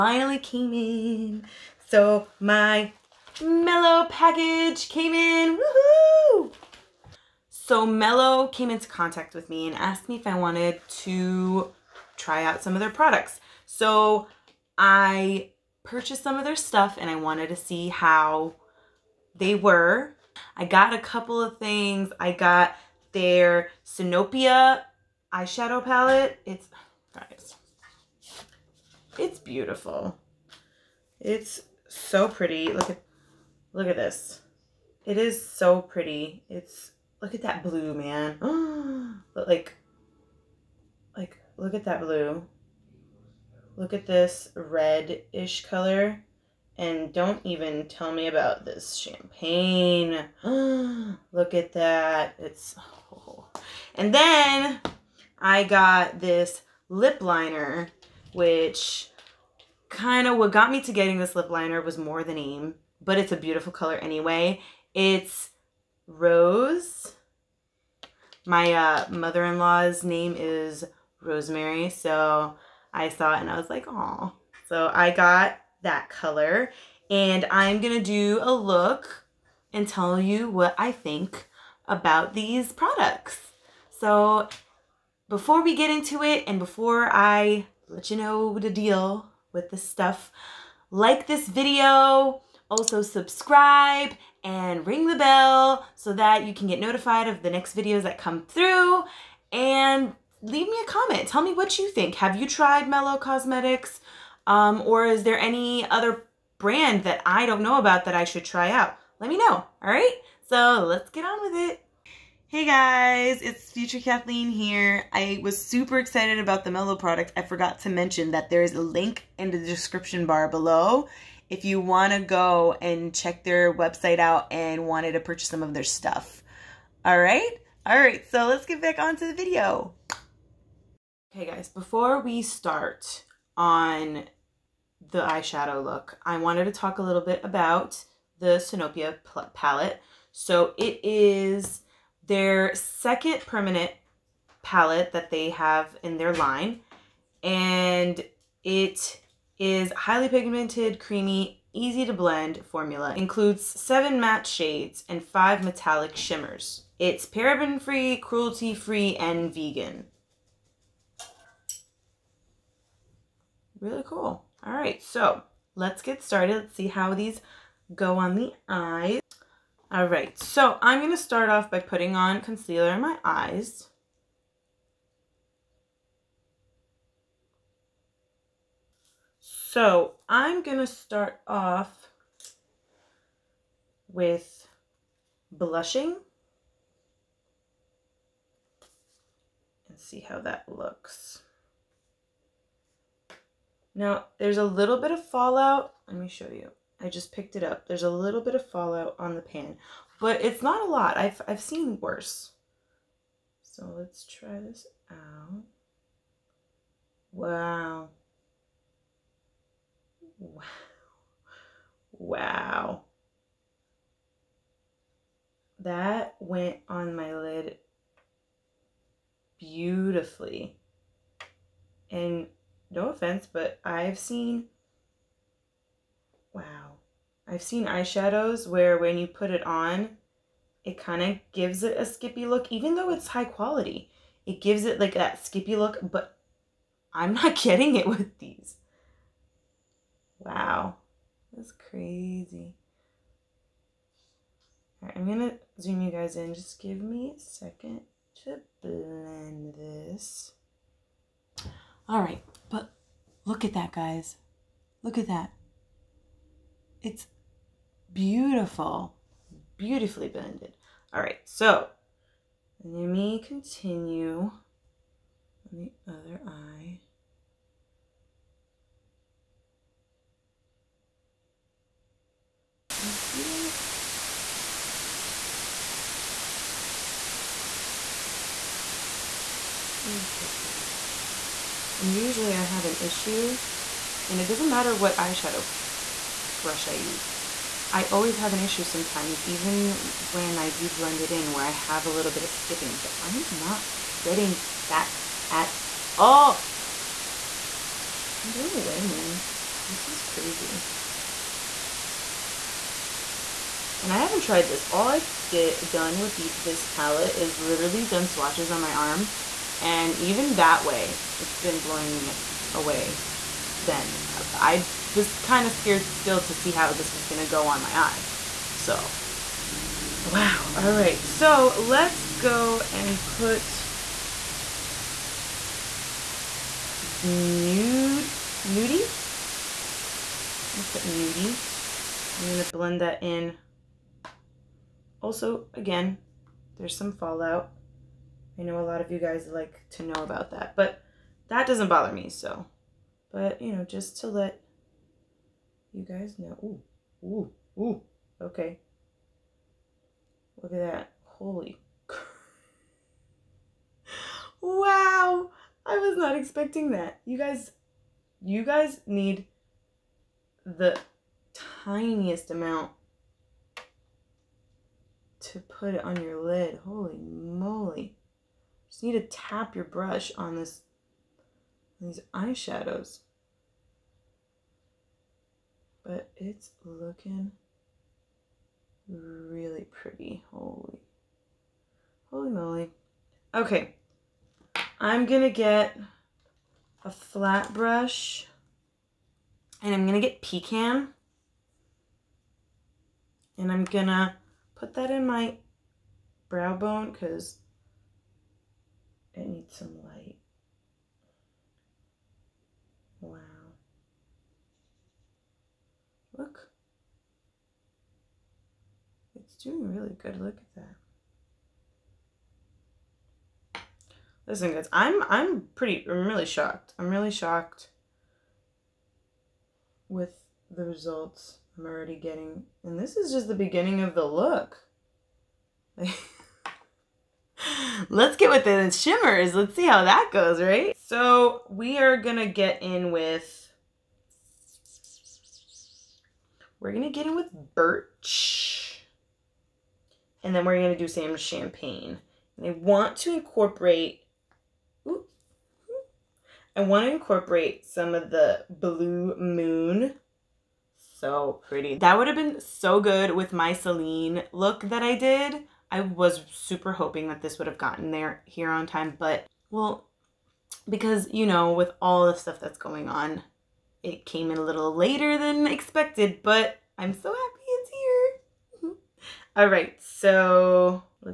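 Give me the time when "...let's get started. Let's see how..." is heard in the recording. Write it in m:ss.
2:45.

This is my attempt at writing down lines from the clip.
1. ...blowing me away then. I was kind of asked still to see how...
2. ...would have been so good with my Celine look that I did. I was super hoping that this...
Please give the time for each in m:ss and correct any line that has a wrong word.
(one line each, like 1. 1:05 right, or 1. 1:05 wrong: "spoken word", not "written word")
1. 5:11 wrong: "scared", not "asked"
2. 7:32 right.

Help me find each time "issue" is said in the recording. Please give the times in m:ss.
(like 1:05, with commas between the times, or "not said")
4:42, 4:48.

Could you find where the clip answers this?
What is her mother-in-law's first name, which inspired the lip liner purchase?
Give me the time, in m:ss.
1:11.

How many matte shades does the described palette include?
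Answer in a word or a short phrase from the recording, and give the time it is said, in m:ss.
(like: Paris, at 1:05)
7, at 2:33.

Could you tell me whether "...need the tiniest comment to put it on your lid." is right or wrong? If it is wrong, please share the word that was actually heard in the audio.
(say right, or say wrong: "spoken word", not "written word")
wrong: "amount", not "comment".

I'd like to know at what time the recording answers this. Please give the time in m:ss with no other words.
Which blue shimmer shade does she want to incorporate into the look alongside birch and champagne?
7:28.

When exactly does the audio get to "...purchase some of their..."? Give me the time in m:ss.
2:05.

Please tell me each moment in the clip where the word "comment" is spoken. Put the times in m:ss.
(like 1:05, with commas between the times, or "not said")
1:40.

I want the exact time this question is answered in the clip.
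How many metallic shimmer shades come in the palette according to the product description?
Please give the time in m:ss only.
2:35.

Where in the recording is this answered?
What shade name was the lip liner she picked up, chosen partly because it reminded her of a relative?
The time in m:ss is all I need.
1:06.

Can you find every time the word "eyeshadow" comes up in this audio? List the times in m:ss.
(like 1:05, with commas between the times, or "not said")
0:25, 2:15, 3:47, 4:45, 6:12.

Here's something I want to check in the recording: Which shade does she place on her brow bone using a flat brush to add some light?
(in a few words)
Pecan.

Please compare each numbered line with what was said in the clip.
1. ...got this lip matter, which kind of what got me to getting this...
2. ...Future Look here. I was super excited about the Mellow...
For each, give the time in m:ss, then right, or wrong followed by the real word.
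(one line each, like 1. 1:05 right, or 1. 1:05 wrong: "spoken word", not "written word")
1. 0:55 wrong: "liner", not "matter"
2. 1:53 wrong: "Kathleen", not "Look".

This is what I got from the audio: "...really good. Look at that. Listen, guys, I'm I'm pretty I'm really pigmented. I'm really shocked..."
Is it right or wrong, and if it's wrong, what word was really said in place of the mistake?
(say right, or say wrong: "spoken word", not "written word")
wrong: "shocked", not "pigmented".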